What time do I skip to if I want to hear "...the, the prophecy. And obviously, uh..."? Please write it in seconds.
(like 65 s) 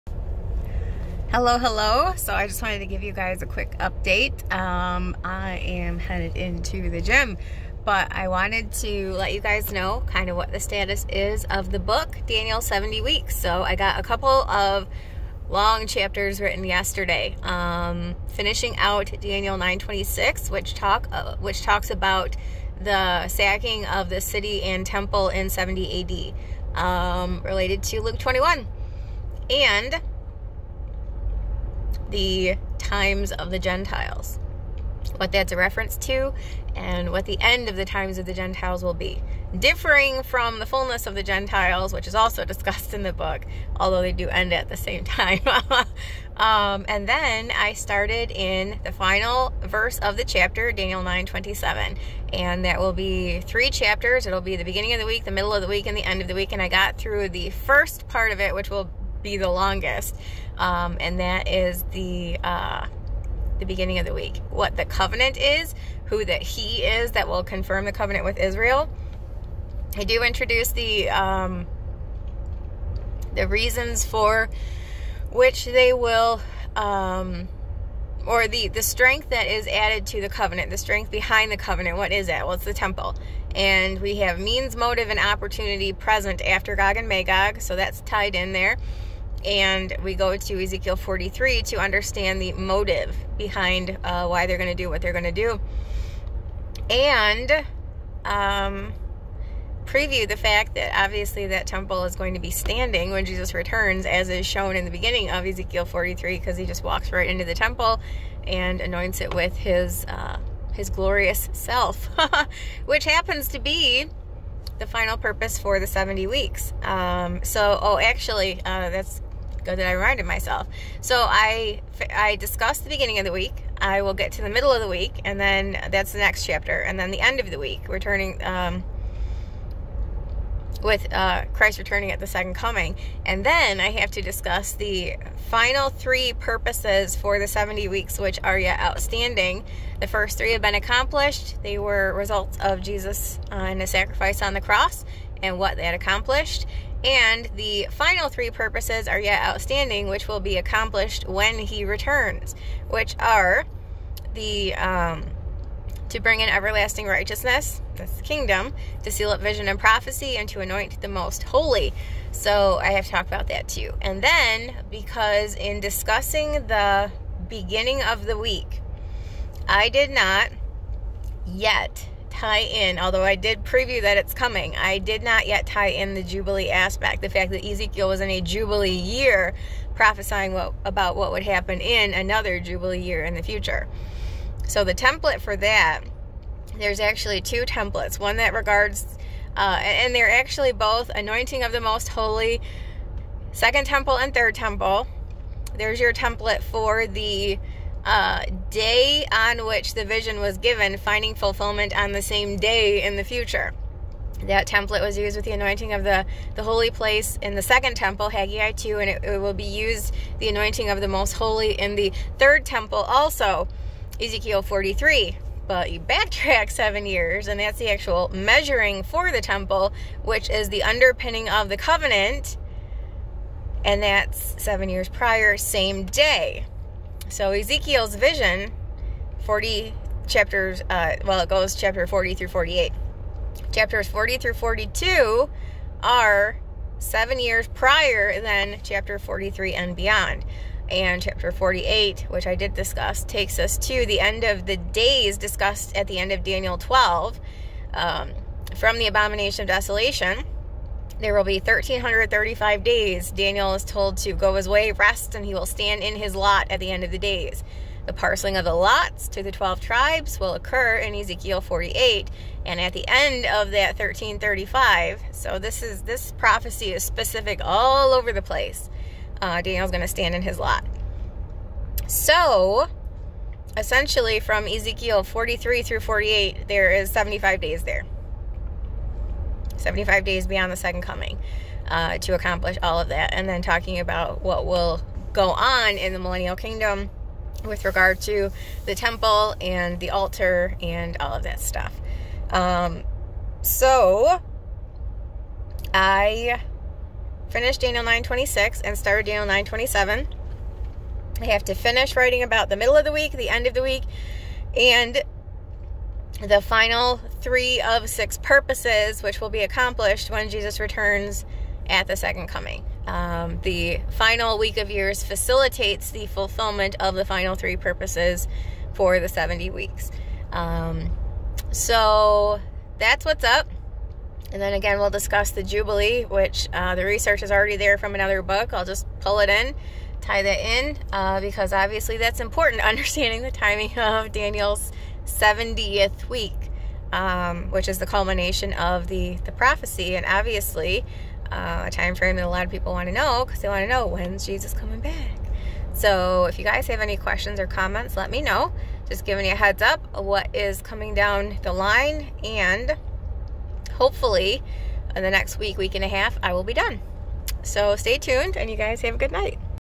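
339 s.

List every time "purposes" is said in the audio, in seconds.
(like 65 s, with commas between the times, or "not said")
115 s, 136 s, 148 s, 308 s, 317 s.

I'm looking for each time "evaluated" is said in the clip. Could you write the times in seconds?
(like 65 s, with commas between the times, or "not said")
not said.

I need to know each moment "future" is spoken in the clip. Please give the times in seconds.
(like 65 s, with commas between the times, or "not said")
183 s, 203 s.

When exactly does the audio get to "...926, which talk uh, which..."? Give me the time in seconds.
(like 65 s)
19 s.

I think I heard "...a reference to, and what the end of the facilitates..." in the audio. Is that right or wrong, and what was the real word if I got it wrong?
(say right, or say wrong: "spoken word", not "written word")
wrong: "times", not "facilitates".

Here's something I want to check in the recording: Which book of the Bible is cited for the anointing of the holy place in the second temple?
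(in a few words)
Haggai 2.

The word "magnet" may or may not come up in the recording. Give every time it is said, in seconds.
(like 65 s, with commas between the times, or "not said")
not said.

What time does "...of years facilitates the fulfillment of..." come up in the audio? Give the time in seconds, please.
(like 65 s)
314 s.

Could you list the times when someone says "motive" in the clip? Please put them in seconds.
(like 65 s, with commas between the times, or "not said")
84 s, 92 s.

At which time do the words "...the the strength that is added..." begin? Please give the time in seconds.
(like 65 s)
78 s.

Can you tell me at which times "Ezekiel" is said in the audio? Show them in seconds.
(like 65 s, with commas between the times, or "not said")
90 s, 105 s, 177 s, 214 s, 227 s, 261 s, 274 s.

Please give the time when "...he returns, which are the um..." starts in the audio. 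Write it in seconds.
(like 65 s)
151 s.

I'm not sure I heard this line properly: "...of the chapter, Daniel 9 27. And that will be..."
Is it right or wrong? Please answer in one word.
right.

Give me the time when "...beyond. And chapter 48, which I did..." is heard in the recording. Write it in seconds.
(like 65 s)
239 s.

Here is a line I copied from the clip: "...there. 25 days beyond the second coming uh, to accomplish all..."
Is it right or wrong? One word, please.
wrong.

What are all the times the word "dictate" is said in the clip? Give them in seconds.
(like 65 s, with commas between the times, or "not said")
not said.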